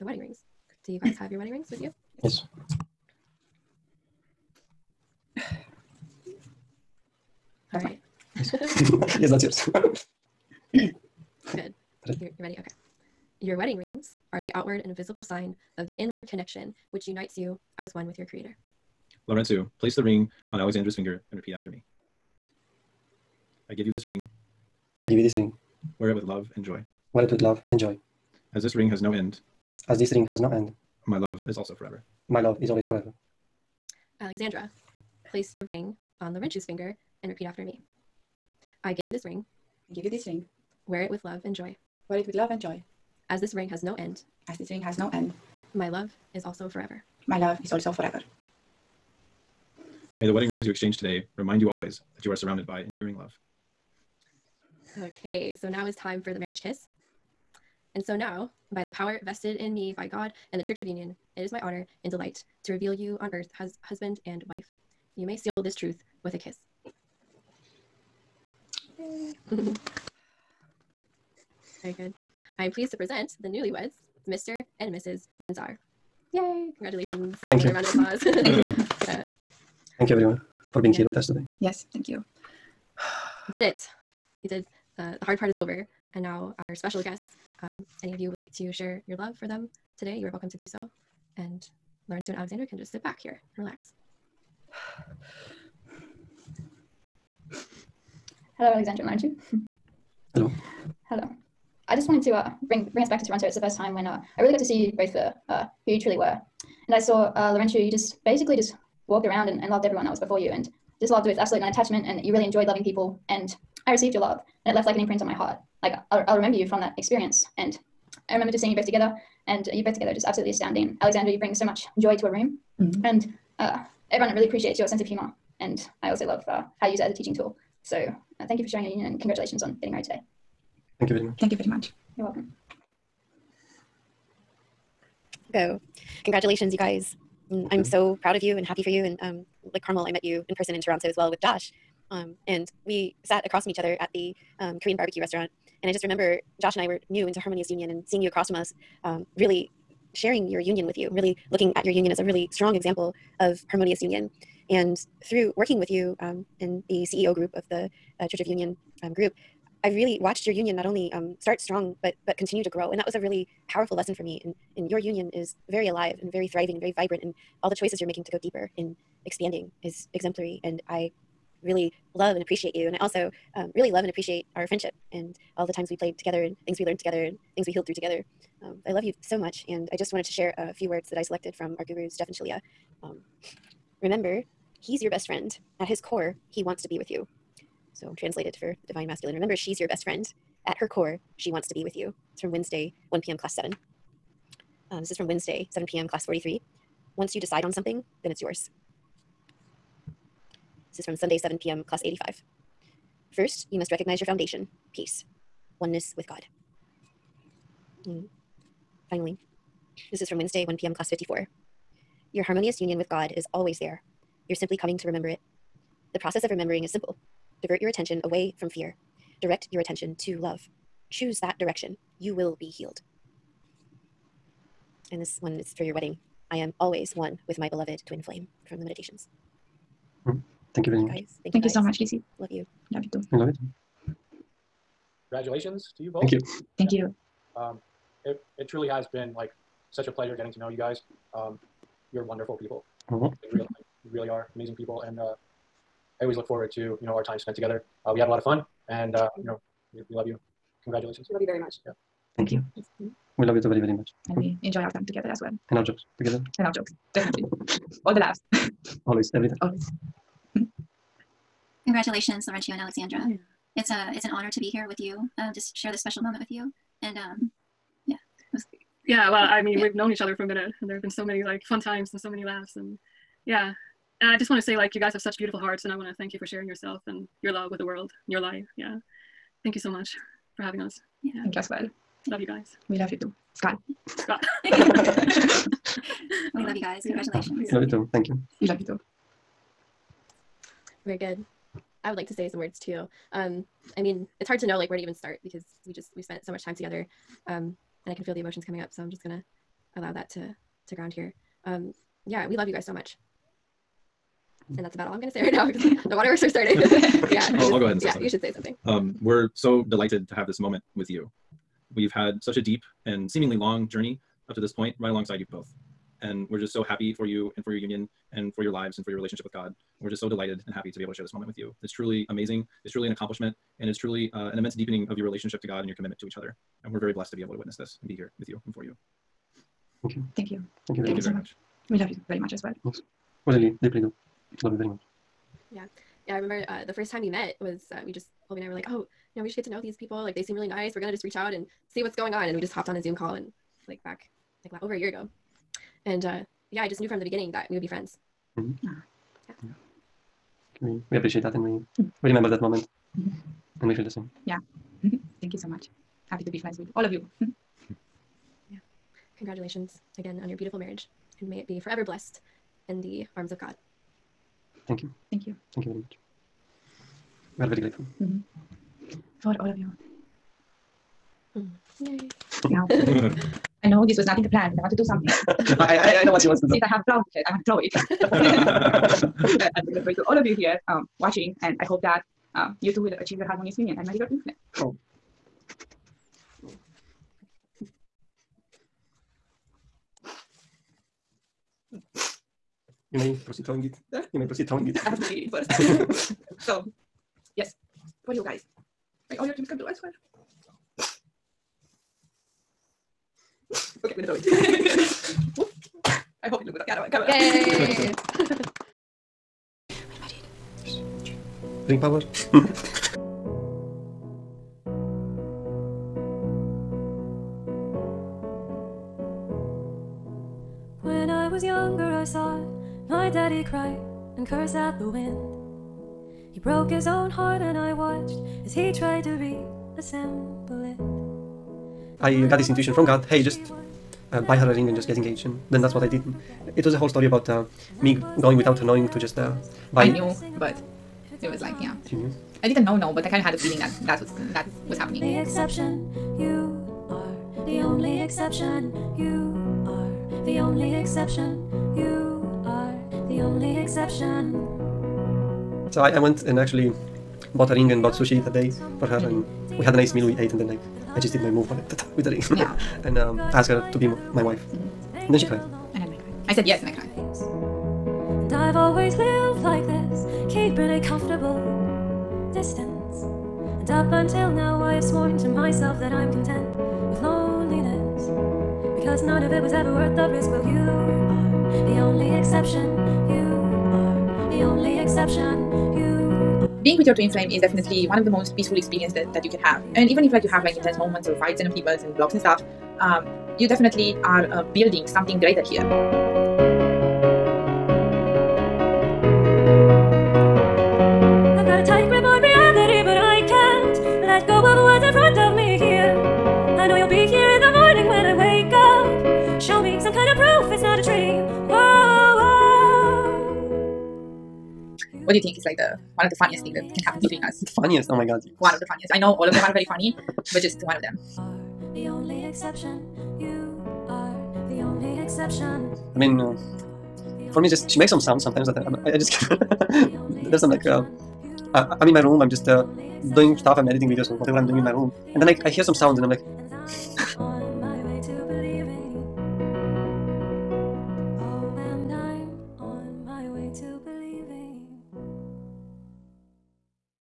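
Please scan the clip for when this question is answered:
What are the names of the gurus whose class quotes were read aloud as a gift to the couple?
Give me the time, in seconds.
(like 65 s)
182 s.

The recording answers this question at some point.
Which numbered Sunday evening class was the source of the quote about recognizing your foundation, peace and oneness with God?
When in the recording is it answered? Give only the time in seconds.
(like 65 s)
201 s.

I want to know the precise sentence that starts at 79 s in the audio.
Thank you, everyone, for being yeah.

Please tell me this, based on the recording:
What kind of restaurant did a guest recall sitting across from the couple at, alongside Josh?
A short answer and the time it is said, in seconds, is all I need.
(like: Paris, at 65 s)
Korean barbecue, at 144 s.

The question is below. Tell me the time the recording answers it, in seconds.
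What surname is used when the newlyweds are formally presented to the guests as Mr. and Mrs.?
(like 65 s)
75 s.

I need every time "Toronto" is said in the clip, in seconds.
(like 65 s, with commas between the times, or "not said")
103 s, 140 s.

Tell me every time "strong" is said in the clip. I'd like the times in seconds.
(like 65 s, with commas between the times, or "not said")
152 s, 161 s.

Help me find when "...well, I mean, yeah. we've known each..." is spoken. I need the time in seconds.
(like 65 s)
269 s.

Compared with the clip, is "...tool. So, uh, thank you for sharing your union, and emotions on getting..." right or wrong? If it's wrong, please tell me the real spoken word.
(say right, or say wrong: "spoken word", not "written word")
wrong: "congratulations", not "emotions".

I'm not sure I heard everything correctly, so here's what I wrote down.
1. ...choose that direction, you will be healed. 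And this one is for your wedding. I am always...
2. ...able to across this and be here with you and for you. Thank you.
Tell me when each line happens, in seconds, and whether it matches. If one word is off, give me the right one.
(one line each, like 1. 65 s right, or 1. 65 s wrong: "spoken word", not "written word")
1. 221 s right
2. 327 s wrong: "witness", not "across".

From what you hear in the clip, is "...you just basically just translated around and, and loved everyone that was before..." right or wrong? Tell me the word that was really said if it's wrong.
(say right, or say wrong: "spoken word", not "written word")
wrong: "walked", not "translated".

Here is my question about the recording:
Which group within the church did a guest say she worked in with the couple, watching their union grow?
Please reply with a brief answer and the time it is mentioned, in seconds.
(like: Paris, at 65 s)
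CEO group, at 157 s.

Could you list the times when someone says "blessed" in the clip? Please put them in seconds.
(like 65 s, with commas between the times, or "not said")
327 s, 362 s.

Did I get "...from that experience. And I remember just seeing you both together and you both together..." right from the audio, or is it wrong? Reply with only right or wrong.
right.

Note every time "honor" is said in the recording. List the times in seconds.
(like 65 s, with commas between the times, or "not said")
61 s, 264 s.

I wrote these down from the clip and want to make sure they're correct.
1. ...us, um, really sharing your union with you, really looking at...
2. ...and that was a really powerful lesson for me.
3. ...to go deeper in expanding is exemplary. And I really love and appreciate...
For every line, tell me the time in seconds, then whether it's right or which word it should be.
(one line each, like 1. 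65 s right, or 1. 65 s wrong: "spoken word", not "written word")
1. 148 s right
2. 162 s right
3. 168 s right.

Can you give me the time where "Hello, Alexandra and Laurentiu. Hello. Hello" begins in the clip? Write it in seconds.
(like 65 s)
98 s.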